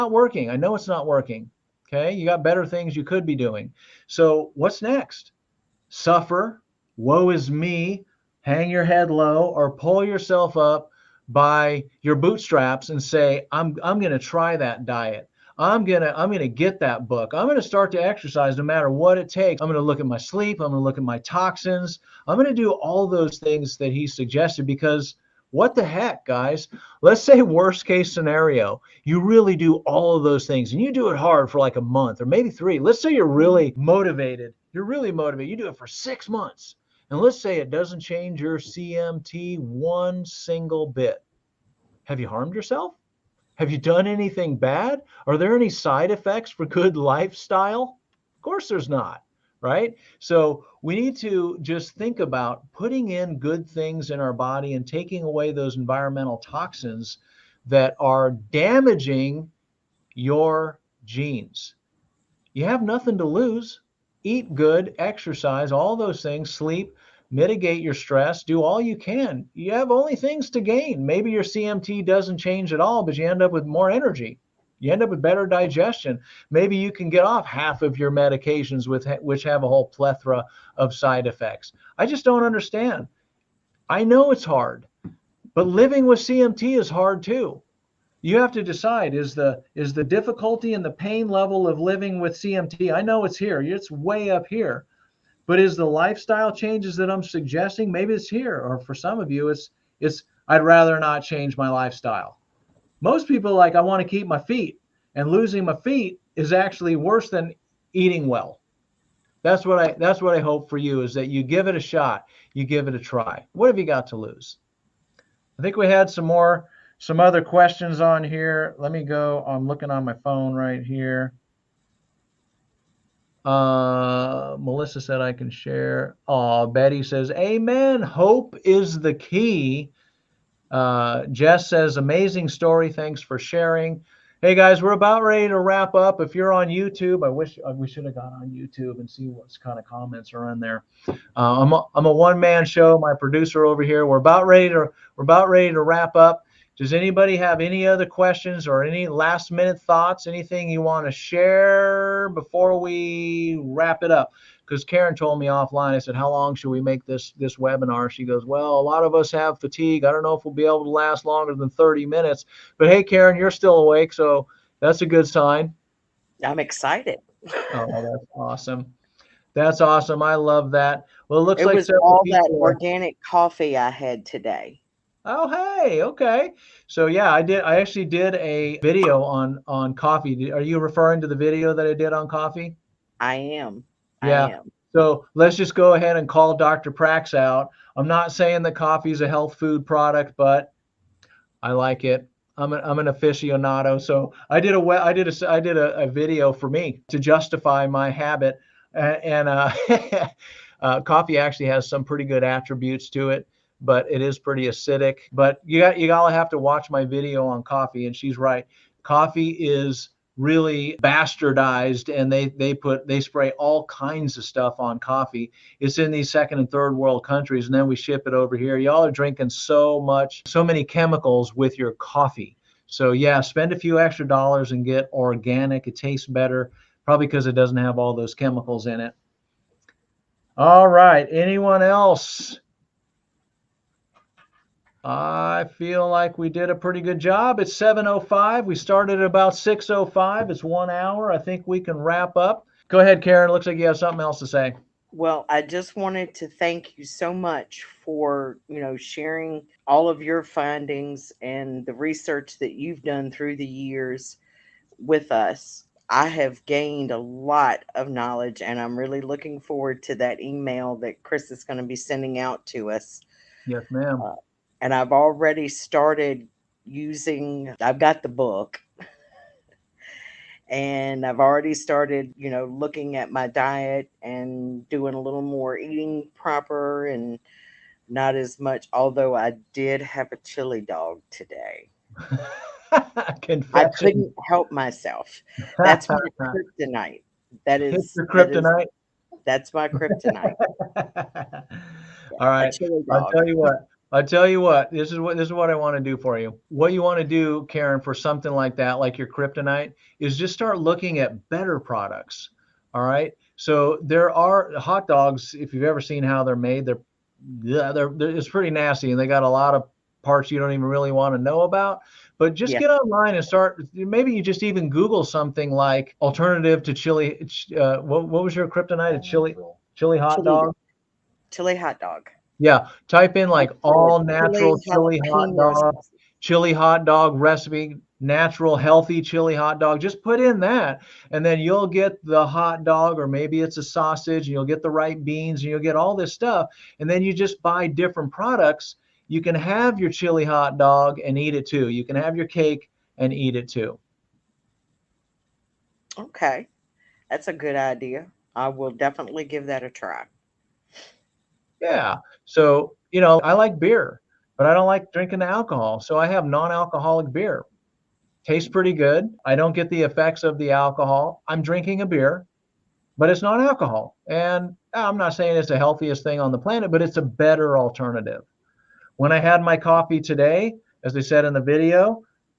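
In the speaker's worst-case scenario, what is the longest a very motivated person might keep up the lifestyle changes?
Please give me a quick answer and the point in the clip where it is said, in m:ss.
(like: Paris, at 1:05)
6 months, at 0:35.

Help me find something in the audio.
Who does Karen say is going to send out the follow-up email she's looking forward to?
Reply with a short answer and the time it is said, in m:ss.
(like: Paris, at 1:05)
Chris, at 4:21.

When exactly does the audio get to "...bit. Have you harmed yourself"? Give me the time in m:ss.
0:40.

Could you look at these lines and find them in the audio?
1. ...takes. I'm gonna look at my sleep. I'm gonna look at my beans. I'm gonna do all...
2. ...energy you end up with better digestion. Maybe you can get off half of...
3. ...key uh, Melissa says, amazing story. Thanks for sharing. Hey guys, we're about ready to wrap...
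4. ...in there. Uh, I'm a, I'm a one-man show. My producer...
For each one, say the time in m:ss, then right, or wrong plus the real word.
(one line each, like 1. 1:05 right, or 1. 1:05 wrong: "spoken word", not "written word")
1. 0:19 wrong: "toxins", not "beans"
2. 1:13 right
3. 2:09 wrong: "Jess", not "Melissa"
4. 2:20 right.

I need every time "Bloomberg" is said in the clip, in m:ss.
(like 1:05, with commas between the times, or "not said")
not said.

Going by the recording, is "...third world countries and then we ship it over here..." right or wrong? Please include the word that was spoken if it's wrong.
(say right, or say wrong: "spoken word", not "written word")
right.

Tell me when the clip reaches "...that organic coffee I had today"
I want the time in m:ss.
2:52.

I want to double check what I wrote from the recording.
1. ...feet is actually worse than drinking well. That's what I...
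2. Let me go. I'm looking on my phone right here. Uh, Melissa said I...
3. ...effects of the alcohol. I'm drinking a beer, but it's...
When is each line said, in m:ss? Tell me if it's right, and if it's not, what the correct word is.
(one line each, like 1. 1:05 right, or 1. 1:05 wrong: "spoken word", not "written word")
1. 1:45 wrong: "eating", not "drinking"
2. 1:58 right
3. 6:00 right.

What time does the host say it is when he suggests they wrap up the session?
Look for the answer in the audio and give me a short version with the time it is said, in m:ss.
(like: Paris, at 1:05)
7:05, at 3:57.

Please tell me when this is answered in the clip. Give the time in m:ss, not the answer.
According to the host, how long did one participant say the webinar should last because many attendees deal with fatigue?
2:41.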